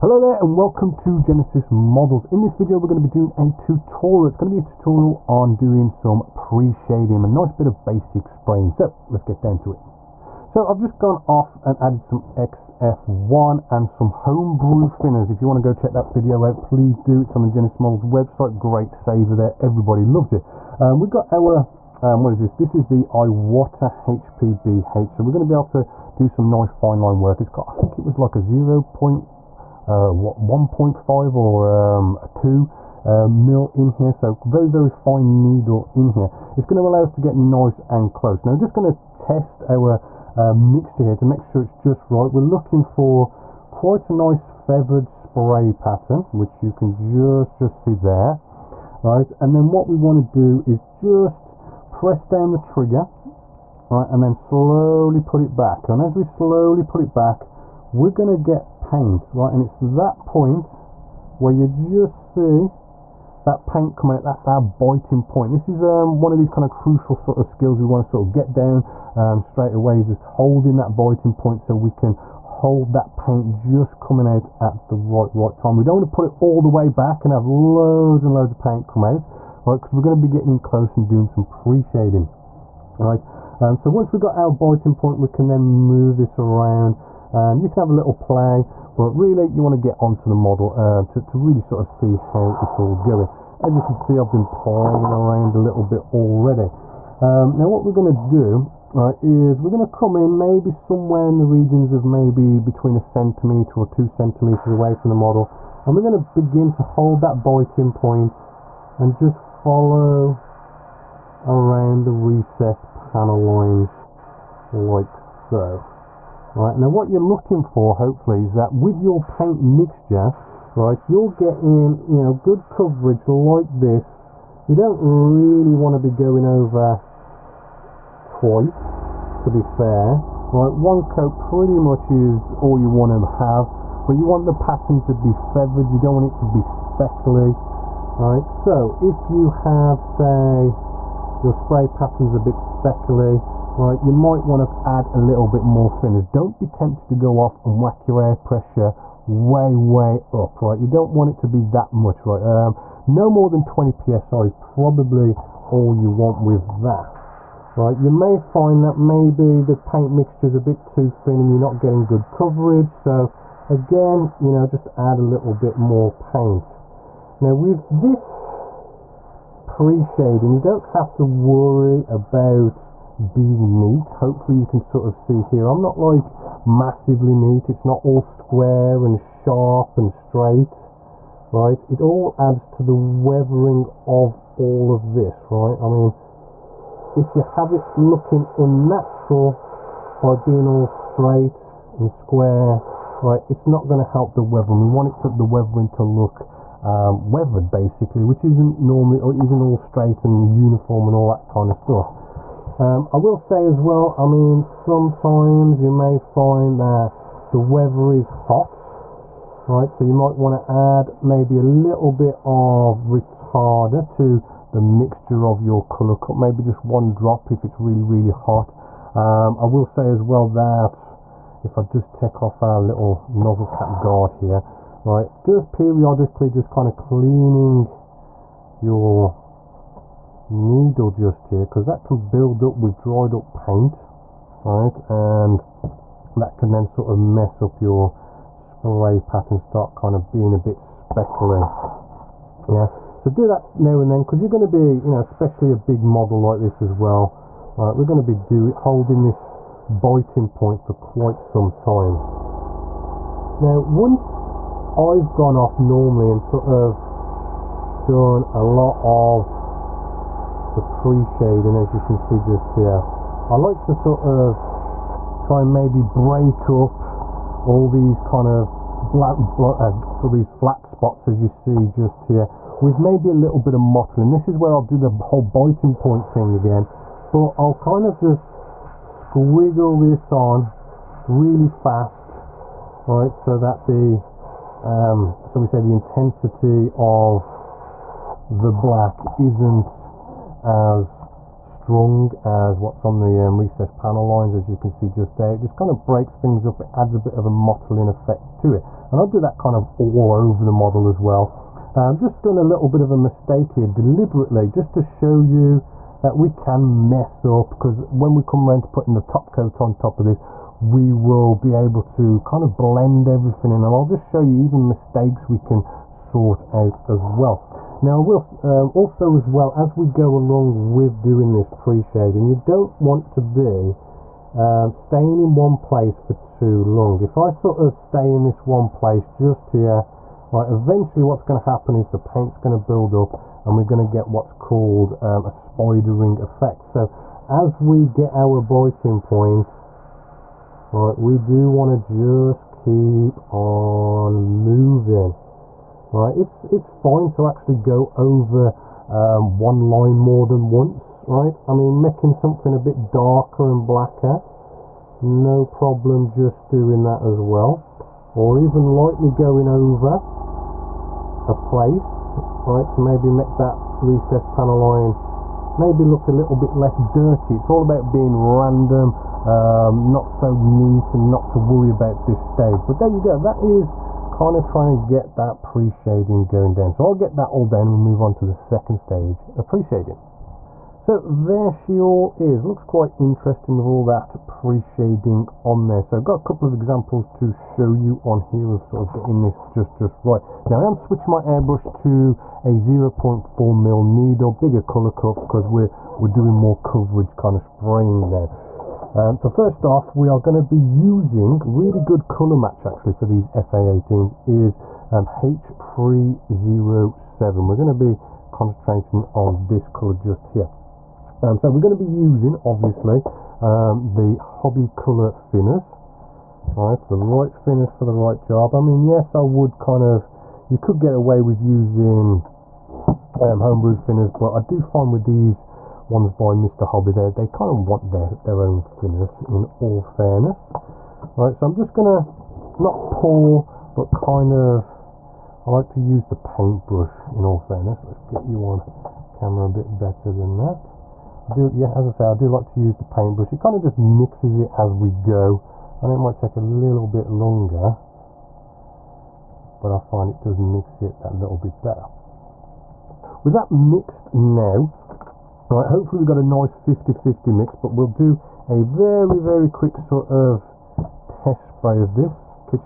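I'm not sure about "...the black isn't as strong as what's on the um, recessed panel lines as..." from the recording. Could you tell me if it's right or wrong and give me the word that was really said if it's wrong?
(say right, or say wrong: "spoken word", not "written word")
right.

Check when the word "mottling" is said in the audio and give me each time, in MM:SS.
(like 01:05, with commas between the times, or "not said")
04:33, 04:57.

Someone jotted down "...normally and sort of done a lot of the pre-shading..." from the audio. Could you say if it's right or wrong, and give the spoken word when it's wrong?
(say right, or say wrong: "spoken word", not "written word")
right.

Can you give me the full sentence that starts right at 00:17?
It's on the Genessis Models website.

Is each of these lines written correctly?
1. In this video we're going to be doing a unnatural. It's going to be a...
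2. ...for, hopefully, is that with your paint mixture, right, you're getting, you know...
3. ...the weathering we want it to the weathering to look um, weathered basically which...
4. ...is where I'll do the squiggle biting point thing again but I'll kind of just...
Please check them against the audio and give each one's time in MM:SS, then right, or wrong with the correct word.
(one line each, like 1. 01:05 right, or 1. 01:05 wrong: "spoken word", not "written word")
1. 00:02 wrong: "tutorial", not "unnatural"
2. 01:57 right
3. 03:14 right
4. 04:34 wrong: "whole", not "squiggle".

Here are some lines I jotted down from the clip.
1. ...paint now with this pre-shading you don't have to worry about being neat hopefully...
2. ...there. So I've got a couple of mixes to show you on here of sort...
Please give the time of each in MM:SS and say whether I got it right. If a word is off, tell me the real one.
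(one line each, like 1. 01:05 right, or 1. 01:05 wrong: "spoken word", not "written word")
1. 02:46 right
2. 06:25 wrong: "examples", not "mixes".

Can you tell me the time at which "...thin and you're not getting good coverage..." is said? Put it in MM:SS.
02:41.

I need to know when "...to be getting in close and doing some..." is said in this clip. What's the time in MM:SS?
01:20.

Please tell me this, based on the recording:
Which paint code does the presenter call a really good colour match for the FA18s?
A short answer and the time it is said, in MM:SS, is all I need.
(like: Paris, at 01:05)
H307, at 06:45.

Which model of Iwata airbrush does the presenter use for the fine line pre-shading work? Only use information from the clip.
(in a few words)
HPBH.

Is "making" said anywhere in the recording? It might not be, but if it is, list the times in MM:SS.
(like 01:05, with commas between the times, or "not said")
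05:52.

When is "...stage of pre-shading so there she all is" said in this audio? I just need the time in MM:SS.
06:18.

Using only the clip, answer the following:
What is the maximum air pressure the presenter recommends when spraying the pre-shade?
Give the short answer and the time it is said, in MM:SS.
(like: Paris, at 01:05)
20 psi, at 02:33.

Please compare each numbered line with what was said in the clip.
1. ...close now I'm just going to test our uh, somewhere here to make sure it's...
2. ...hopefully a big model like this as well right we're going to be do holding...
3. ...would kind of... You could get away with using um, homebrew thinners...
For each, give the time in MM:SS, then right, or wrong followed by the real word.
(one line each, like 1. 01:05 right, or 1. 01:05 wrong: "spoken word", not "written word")
1. 00:38 wrong: "mixture", not "somewhere"
2. 04:05 wrong: "especially", not "hopefully"
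3. 06:59 right.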